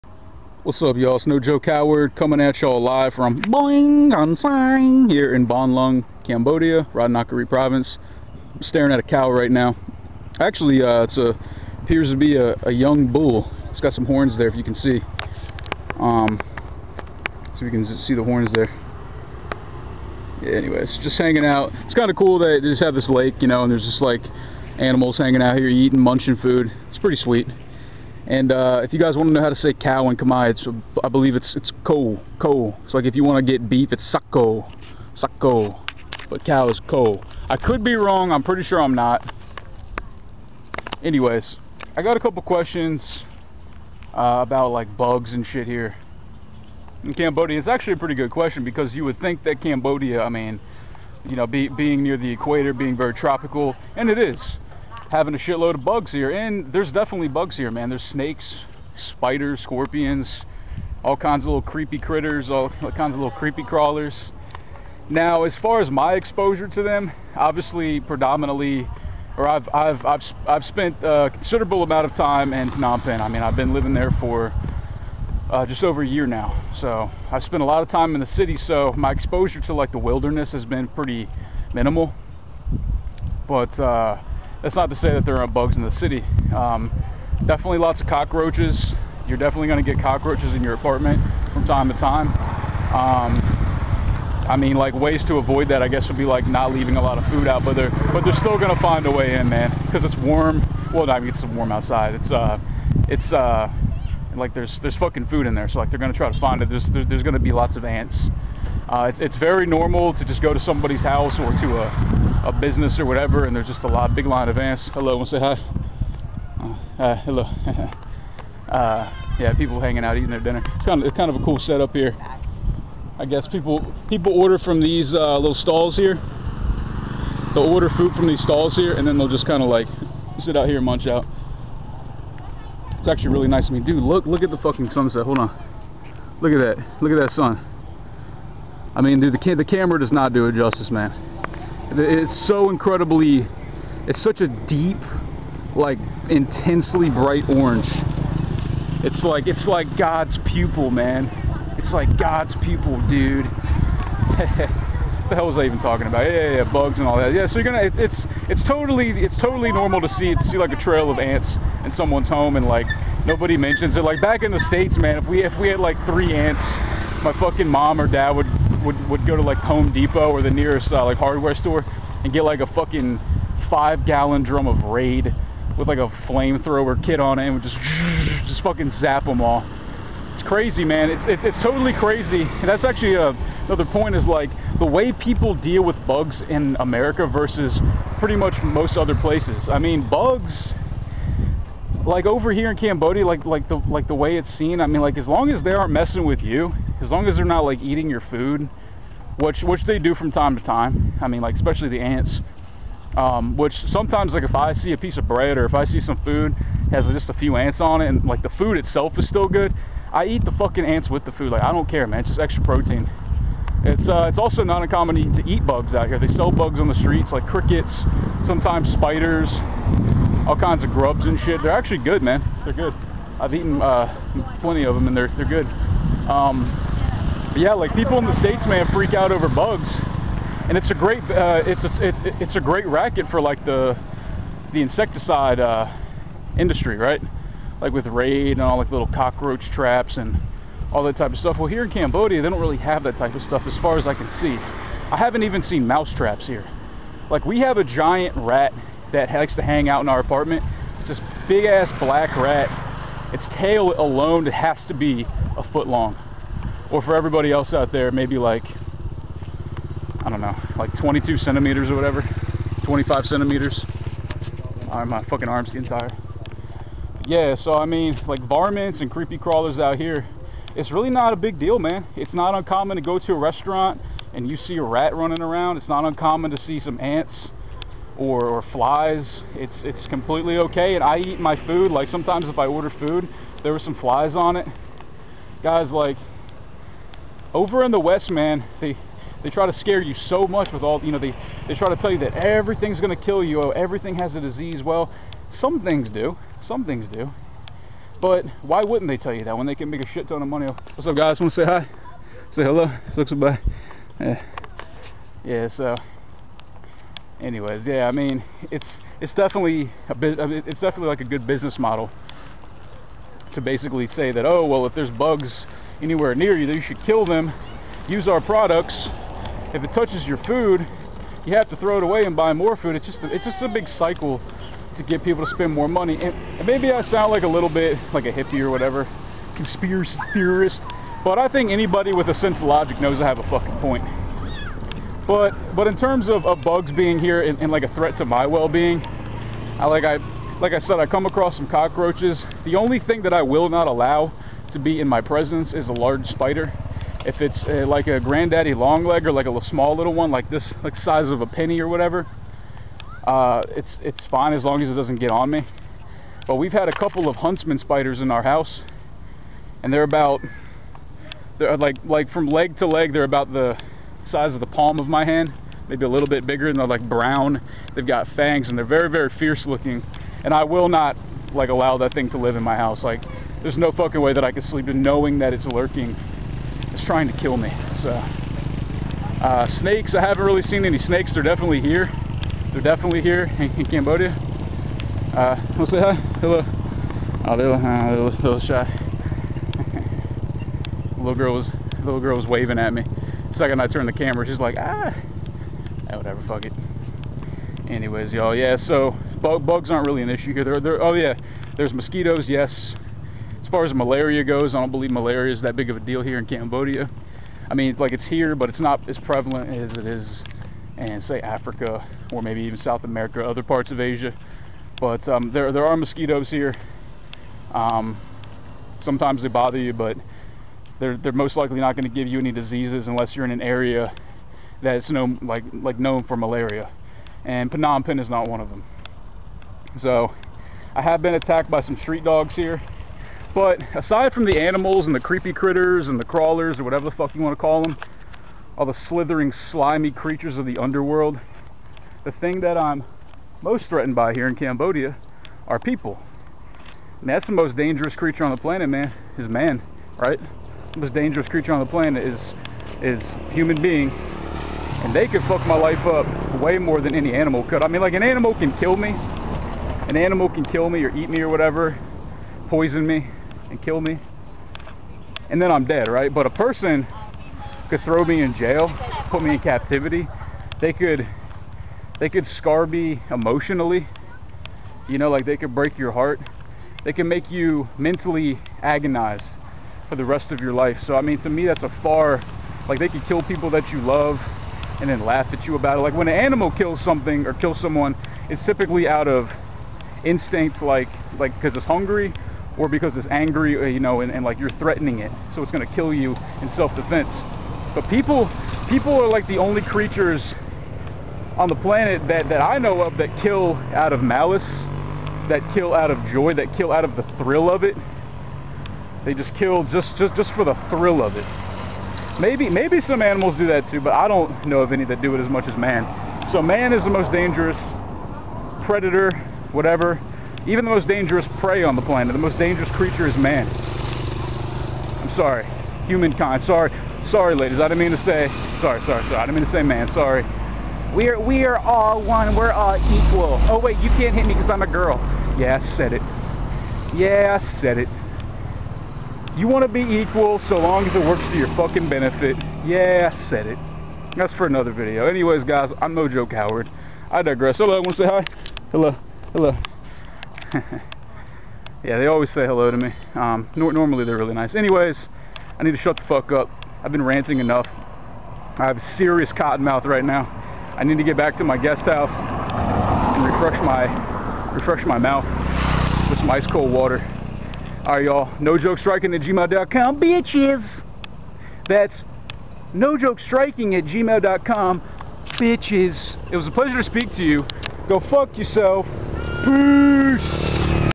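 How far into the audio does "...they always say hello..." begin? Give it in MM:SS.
09:12.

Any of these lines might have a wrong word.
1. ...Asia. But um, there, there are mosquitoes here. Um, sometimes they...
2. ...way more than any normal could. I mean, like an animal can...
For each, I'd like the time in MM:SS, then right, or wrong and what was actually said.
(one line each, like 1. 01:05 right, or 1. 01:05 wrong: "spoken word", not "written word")
1. 06:54 right
2. 07:36 wrong: "animal", not "normal".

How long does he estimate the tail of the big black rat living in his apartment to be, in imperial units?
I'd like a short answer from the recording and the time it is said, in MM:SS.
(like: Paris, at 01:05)
a foot, at 04:15.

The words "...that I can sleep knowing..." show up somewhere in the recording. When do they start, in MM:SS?
06:14.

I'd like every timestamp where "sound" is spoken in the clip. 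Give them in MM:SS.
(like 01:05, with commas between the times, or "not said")
05:27.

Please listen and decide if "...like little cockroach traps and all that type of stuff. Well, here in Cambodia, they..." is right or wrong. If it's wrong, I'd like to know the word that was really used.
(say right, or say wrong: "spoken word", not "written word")
right.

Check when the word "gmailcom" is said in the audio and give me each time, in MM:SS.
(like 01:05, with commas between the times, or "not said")
09:29, 09:34.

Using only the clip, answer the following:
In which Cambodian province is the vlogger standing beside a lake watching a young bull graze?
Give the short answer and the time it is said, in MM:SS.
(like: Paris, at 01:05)
Ratanakiri, at 00:06.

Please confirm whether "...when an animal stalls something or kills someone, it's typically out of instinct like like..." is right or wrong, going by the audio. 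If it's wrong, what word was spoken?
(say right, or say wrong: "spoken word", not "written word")
wrong: "kills", not "stalls".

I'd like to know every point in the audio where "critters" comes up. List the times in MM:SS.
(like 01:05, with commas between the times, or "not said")
01:01, 07:15.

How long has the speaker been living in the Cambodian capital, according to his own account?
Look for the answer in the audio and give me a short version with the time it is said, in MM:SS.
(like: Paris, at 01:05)
just over a year, at 01:15.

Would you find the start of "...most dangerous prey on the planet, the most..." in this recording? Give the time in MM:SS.
08:40.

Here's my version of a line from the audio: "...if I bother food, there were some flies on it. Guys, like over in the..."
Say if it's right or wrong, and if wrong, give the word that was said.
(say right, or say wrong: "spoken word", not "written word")
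wrong: "order", not "bother".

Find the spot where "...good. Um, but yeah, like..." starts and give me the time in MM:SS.
03:45.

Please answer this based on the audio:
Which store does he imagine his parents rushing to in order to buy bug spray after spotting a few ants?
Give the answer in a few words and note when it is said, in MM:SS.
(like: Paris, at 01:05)
Home Depot, at 02:49.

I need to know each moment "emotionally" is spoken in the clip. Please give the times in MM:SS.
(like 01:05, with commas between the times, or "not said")
07:53.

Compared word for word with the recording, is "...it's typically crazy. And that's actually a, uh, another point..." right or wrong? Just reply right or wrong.
wrong.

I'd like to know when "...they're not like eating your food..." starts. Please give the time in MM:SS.
03:17.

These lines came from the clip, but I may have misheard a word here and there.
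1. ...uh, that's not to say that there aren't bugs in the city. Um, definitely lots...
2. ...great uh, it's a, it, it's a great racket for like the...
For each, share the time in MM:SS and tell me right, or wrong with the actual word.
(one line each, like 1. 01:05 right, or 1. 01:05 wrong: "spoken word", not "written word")
1. 01:23 right
2. 03:50 right.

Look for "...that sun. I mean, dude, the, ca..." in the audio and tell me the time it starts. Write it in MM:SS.
02:17.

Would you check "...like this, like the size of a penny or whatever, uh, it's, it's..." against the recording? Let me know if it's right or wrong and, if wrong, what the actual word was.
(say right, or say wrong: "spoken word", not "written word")
right.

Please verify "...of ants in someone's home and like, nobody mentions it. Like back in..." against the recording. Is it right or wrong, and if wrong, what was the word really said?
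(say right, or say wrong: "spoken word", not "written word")
right.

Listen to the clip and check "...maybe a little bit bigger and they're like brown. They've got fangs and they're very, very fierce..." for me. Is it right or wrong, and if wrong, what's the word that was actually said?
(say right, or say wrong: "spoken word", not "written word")
right.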